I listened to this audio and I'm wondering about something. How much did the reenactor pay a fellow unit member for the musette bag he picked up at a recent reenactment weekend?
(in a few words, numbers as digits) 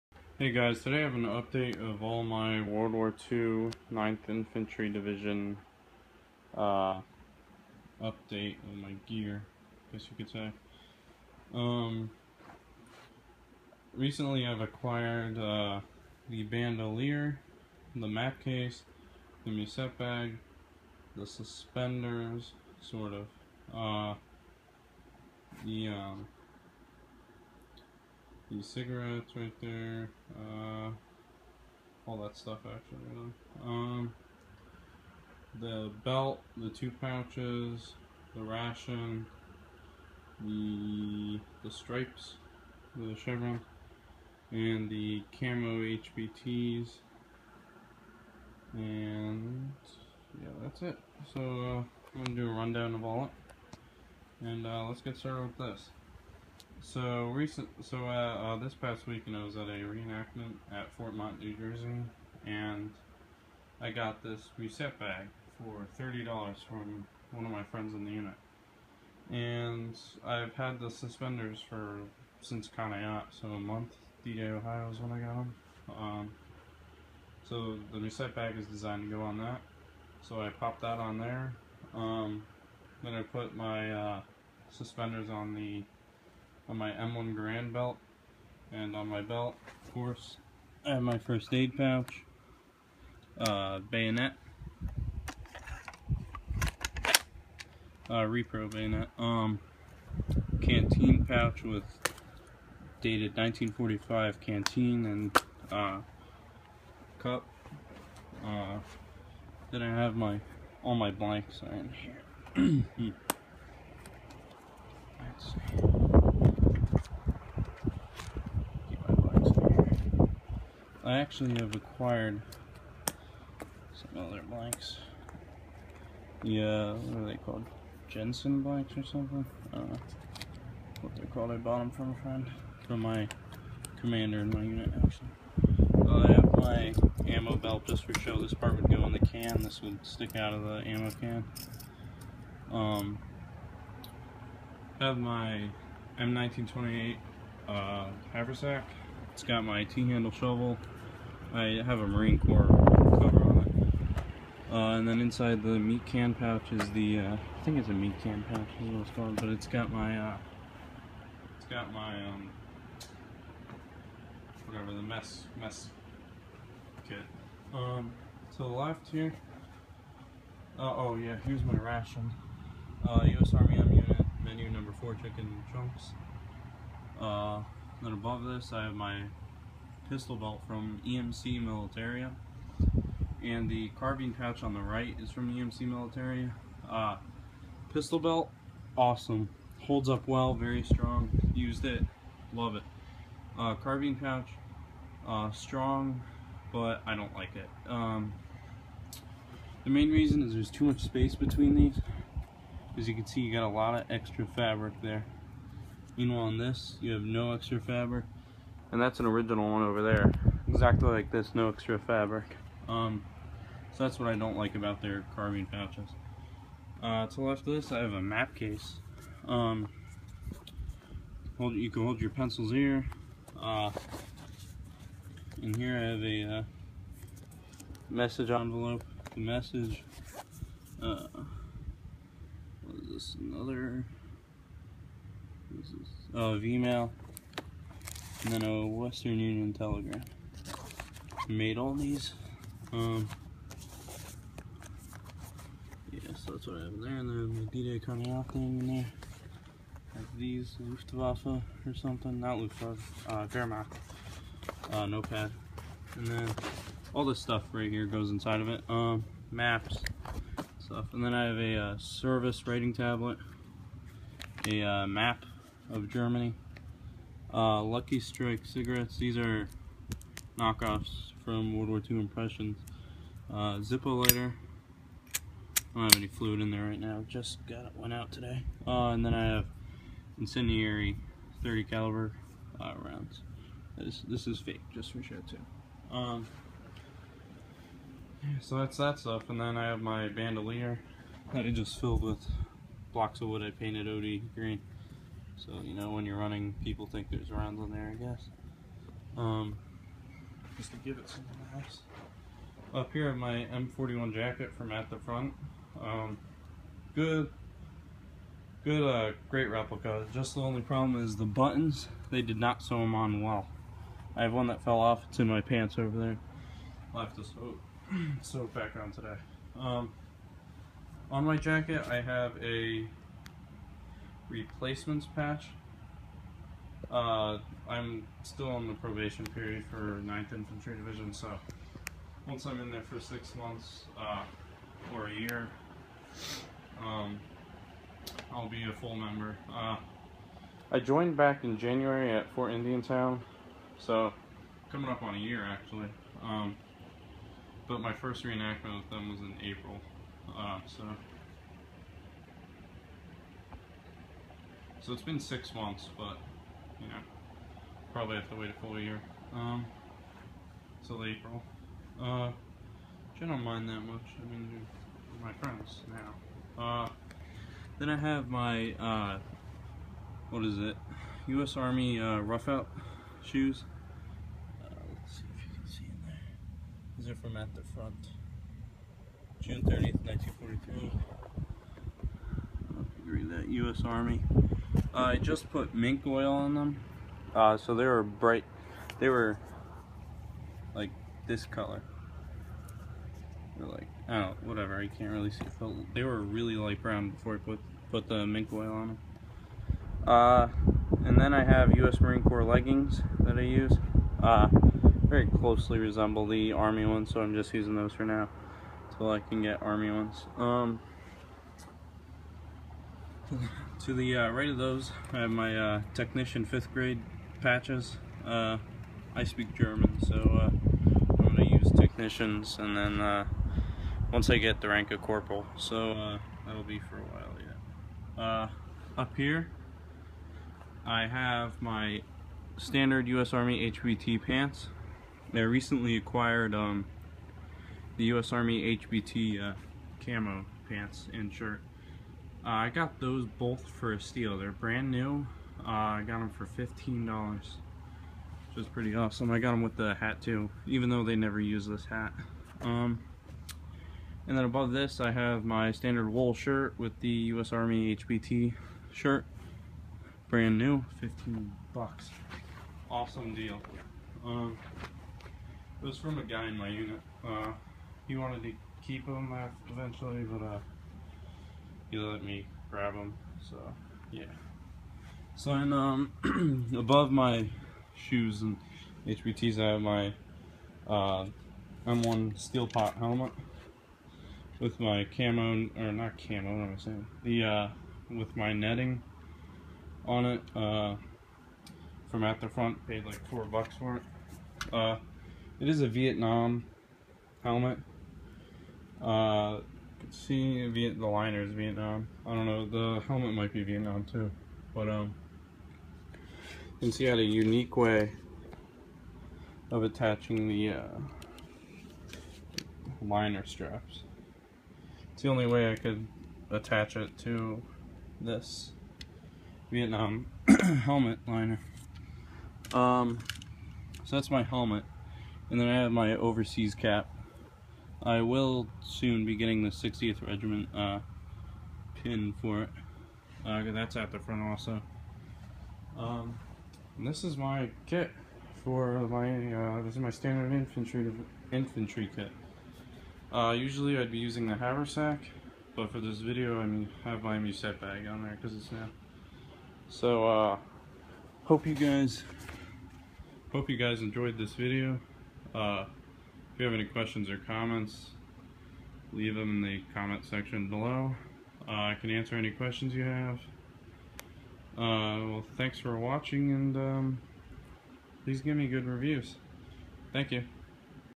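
$30.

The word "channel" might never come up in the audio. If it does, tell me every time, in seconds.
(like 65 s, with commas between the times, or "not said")
not said.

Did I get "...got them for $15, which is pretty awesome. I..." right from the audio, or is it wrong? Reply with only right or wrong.
right.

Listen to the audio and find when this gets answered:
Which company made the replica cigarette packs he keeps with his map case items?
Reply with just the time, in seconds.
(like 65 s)
271 s.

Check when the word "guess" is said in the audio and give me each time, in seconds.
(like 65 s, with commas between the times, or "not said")
9 s, 298 s.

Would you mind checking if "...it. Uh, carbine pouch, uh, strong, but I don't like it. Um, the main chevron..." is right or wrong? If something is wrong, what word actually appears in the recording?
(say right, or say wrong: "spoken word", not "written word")
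wrong: "reason", not "chevron".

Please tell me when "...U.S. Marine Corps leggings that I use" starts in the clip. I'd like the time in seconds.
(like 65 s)
401 s.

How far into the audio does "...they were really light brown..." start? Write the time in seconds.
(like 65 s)
396 s.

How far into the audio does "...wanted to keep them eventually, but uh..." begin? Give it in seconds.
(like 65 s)
468 s.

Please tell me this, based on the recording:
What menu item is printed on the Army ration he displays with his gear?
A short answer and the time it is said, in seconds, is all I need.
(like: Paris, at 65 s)
Chicken chunks, at 175 s.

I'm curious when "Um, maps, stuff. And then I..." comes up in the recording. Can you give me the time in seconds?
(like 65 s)
258 s.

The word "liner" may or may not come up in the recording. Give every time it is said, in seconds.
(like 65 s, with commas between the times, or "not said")
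501 s, 513 s, 521 s.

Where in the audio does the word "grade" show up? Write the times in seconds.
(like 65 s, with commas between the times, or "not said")
416 s.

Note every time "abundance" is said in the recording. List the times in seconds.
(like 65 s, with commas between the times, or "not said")
not said.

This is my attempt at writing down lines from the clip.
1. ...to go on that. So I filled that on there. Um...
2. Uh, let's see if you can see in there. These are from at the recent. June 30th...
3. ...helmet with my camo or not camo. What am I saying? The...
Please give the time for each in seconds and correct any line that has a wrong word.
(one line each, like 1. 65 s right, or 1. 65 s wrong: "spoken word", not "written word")
1. 79 s wrong: "popped", not "filled"
2. 374 s wrong: "front", not "recent"
3. 483 s right.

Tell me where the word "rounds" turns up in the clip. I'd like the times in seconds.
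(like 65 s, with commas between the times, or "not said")
283 s, 297 s.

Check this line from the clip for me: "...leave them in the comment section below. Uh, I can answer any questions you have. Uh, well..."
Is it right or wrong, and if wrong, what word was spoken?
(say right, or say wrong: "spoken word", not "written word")
right.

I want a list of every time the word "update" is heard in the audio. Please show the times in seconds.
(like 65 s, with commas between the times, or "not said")
1 s, 8 s.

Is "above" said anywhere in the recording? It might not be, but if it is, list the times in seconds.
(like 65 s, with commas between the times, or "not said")
178 s, 454 s, 476 s.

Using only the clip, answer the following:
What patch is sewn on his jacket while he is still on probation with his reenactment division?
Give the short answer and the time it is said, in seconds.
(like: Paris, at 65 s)
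Replacements patch, at 324 s.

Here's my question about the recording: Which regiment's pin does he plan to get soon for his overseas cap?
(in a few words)
60th Regiment.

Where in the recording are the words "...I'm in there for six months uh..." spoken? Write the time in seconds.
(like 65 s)
332 s.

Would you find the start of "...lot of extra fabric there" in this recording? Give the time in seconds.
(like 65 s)
203 s.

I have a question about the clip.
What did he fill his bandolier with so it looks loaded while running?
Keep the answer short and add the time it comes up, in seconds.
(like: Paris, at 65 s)
Blocks of wood, at 293 s.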